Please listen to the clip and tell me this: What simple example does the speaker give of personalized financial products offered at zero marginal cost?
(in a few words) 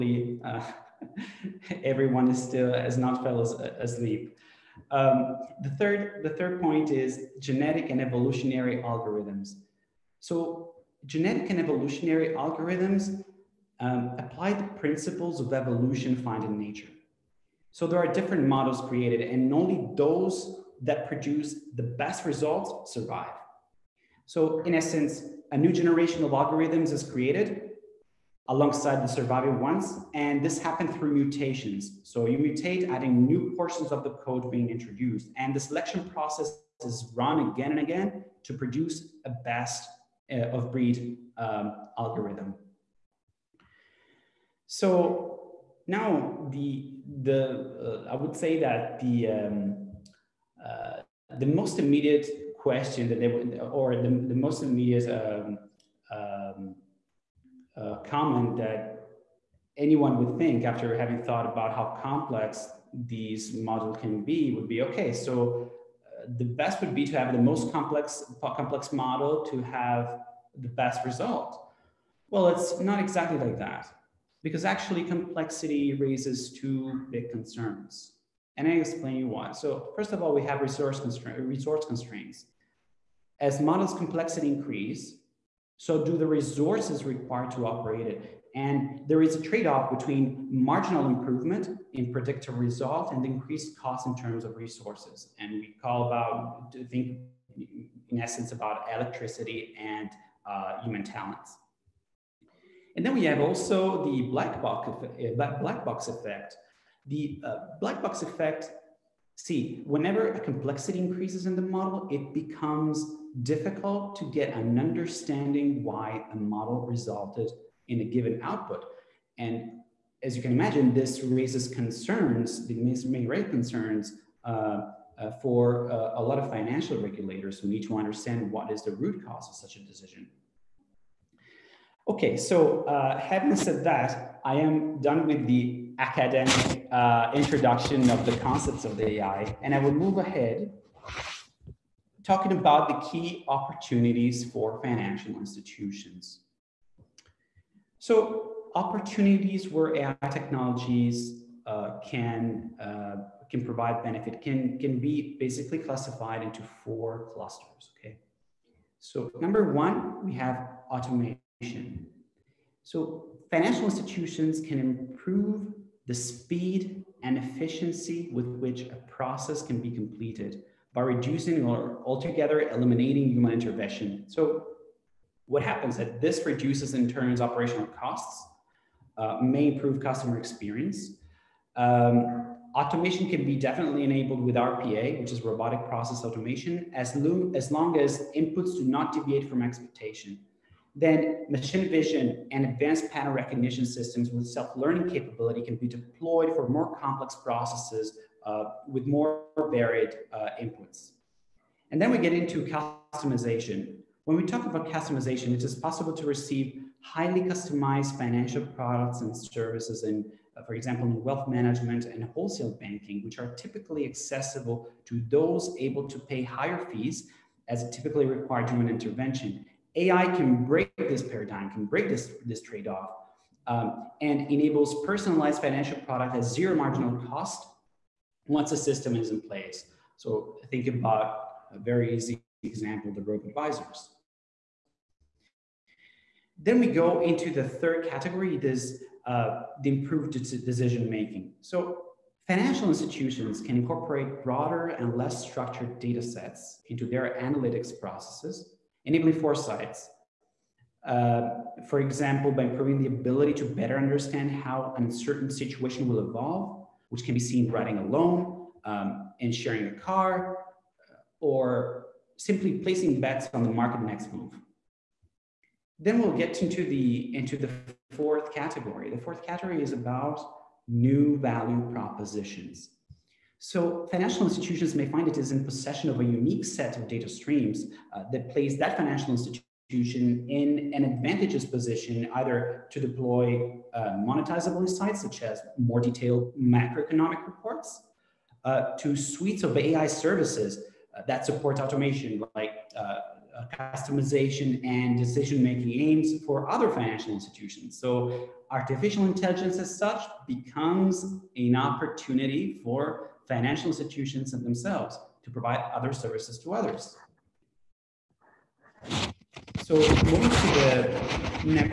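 Robo advisors.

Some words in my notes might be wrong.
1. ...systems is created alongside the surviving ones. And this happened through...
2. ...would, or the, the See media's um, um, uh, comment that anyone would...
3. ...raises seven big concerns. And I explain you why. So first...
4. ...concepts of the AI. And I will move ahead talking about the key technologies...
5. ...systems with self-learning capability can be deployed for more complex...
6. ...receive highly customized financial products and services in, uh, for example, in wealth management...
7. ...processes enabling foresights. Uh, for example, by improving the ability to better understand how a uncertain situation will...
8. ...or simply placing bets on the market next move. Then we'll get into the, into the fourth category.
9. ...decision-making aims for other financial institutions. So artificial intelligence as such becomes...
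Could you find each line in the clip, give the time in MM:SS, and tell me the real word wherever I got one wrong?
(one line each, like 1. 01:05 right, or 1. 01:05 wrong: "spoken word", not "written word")
1. 00:26 wrong: "algorithms", not "systems"
2. 00:53 wrong: "Muslim", not "See"
3. 01:15 wrong: "two", not "seven"
4. 02:18 wrong: "opportunities", not "technologies"
5. 03:13 right
6. 03:26 right
7. 04:08 right
8. 04:21 right
9. 04:55 right.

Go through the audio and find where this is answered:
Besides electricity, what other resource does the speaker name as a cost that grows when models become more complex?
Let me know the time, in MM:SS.
01:40.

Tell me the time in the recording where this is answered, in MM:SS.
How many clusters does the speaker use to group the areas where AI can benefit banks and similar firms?
02:36.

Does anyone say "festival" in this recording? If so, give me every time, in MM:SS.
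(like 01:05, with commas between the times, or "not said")
not said.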